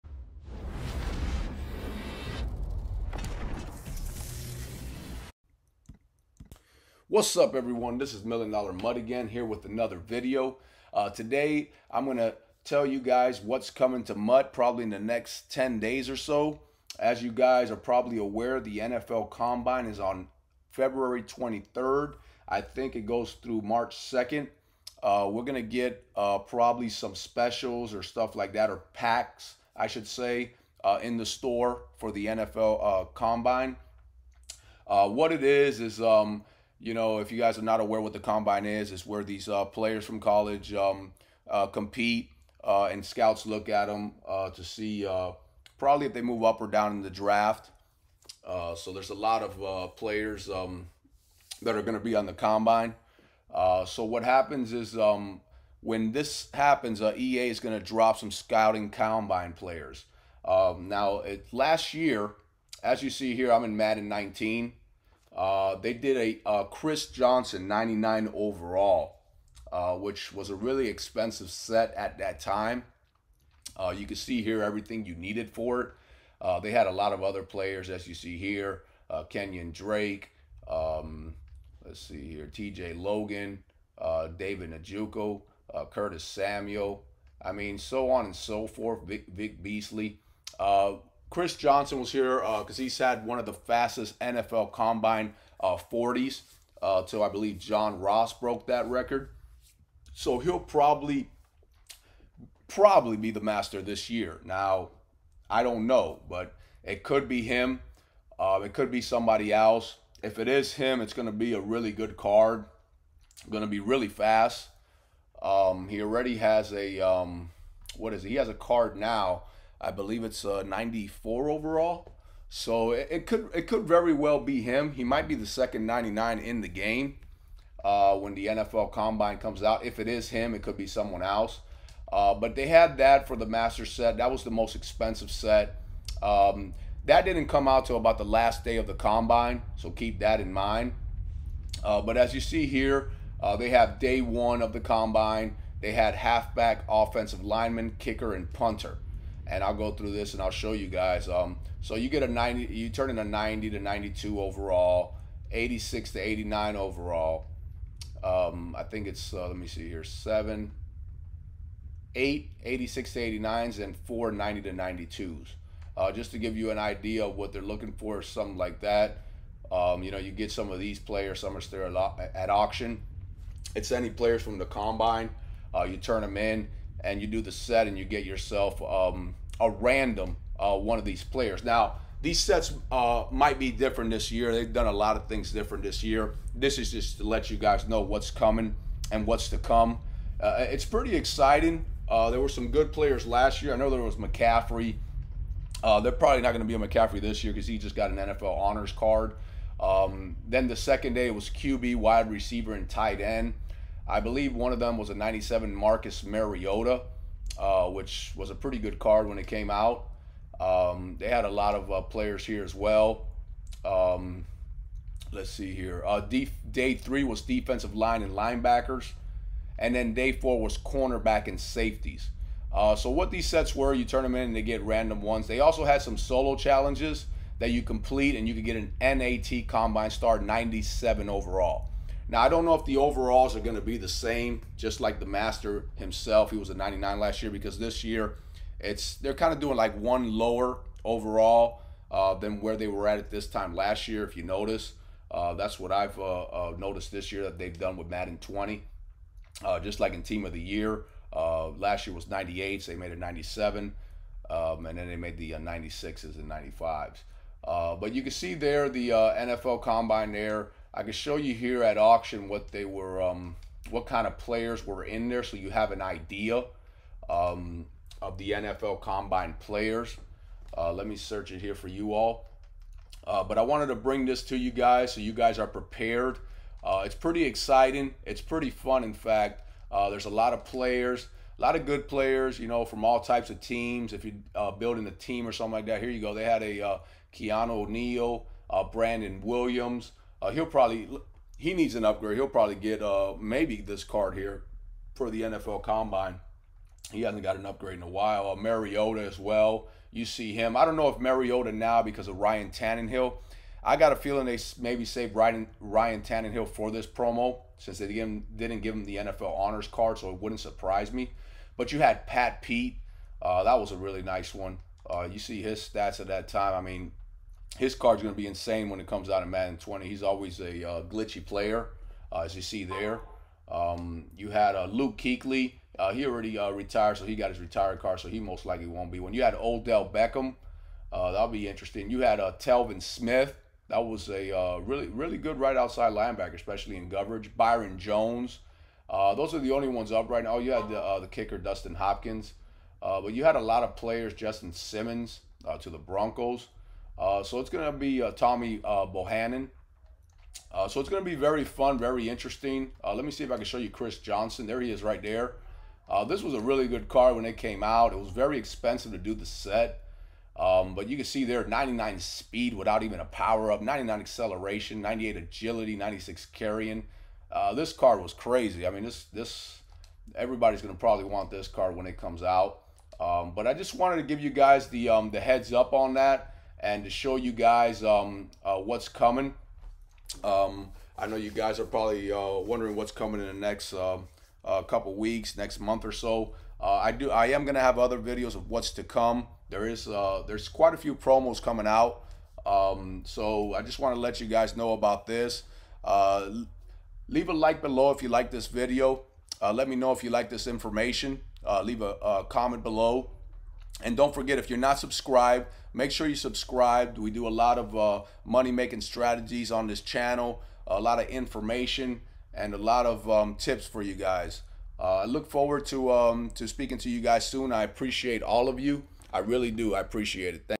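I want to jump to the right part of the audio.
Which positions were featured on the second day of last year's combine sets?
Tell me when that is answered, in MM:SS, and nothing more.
03:21.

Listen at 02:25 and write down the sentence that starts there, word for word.
They had halfback, offensive lineman, kicker, and punter and I'll go through this and I'll show you guys.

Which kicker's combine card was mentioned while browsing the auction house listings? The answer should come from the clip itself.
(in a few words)
Dustin Hopkins.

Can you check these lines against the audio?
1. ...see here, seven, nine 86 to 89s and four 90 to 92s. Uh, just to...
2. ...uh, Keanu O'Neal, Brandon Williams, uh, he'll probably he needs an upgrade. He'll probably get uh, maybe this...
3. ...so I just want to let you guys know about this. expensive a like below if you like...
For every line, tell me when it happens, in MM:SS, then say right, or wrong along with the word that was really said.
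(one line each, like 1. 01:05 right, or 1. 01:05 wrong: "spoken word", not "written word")
1. 02:39 wrong: "eight", not "nine"
2. 04:46 right
3. 06:33 wrong: "leave", not "expensive".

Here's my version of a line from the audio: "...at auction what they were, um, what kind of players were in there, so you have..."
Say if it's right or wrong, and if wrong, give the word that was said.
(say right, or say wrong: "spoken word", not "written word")
right.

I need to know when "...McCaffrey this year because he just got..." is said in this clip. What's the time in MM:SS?
03:16.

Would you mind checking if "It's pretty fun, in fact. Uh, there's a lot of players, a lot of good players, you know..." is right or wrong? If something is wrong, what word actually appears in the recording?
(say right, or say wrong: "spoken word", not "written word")
right.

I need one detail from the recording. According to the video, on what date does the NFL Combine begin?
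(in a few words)
February 23rd.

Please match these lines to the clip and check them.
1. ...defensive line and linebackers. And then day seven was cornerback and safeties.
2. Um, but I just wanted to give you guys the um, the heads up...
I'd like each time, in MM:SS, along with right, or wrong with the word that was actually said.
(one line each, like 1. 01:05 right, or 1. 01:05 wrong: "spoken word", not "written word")
1. 03:37 wrong: "four", not "seven"
2. 06:13 right.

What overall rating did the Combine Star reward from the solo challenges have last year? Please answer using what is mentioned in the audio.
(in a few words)
97.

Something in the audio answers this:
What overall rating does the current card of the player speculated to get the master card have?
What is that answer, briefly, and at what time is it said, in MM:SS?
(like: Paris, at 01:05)
94, at 02:00.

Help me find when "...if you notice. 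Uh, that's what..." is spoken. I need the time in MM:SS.
04:04.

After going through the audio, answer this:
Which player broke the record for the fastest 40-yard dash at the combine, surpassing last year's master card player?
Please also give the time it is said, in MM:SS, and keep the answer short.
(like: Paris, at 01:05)
John Ross, at 01:37.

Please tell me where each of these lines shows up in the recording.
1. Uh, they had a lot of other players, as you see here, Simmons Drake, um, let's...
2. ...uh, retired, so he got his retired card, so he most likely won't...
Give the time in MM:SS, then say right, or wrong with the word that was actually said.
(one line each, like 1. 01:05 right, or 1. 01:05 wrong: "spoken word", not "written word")
1. 01:16 wrong: "Kenyon", not "Simmons"
2. 05:26 right.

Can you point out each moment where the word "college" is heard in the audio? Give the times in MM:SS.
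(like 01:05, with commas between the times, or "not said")
00:40.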